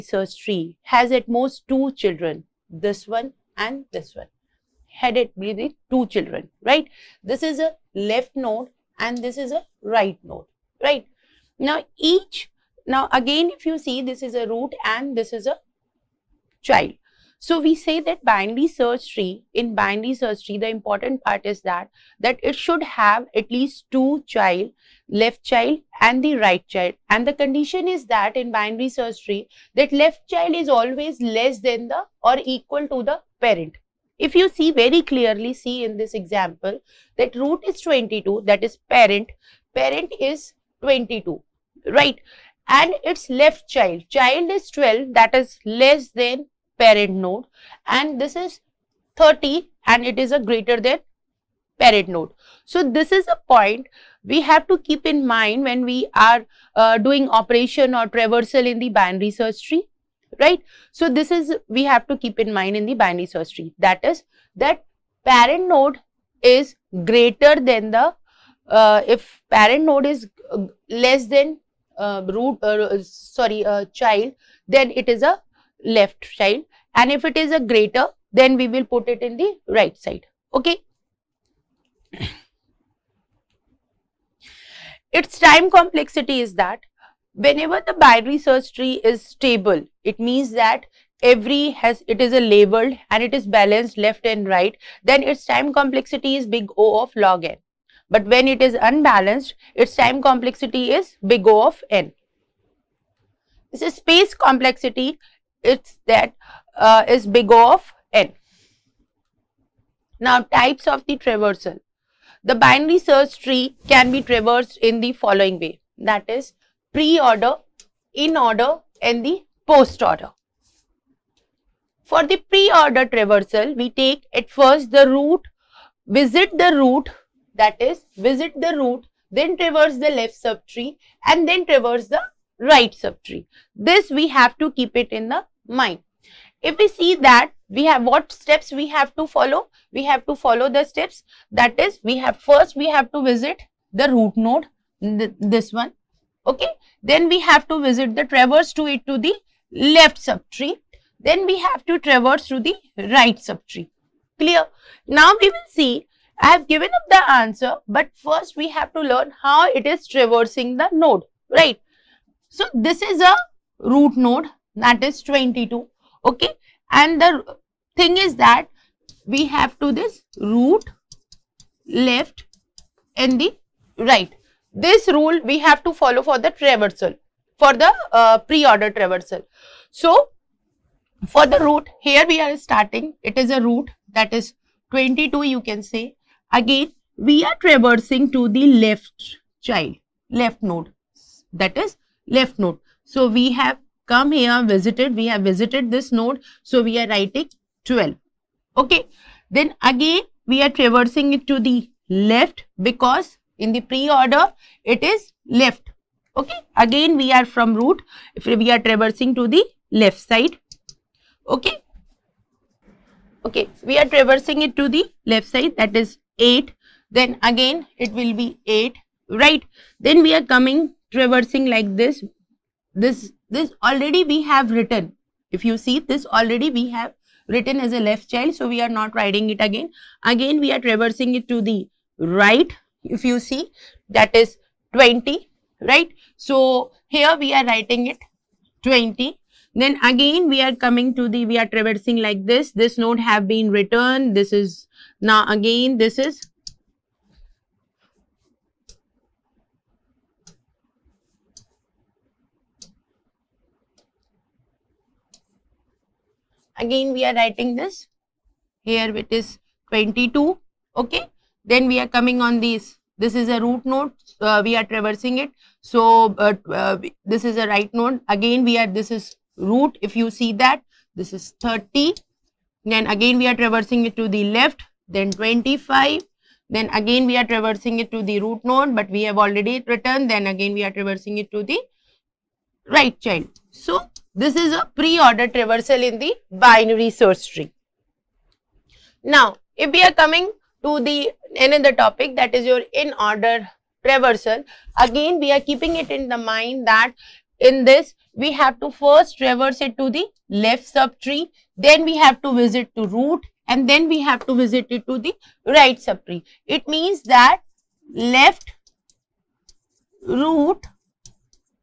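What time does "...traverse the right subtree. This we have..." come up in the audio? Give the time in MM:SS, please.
02:11.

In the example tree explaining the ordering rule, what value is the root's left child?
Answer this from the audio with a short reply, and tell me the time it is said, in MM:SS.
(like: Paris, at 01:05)
12, at 00:44.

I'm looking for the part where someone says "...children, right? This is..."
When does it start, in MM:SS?
00:06.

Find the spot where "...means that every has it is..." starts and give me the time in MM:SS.
01:30.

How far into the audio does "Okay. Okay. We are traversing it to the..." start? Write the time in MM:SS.
03:31.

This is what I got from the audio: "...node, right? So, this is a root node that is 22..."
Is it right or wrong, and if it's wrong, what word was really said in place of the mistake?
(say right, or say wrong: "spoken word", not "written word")
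right.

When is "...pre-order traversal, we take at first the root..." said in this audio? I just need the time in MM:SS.
02:02.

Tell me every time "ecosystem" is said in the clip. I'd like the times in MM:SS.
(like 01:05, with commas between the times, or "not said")
not said.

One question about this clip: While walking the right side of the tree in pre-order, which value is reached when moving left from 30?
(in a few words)
25.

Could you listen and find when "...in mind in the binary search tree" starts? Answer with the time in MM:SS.
01:02.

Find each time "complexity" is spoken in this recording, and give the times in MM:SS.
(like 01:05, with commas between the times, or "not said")
01:25, 01:35, 01:40, 01:44.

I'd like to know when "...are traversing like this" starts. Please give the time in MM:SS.
04:01.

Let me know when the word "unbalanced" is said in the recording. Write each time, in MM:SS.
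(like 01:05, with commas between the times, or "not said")
01:38.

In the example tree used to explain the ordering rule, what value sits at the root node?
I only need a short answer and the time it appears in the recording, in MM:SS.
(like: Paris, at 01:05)
22, at 00:37.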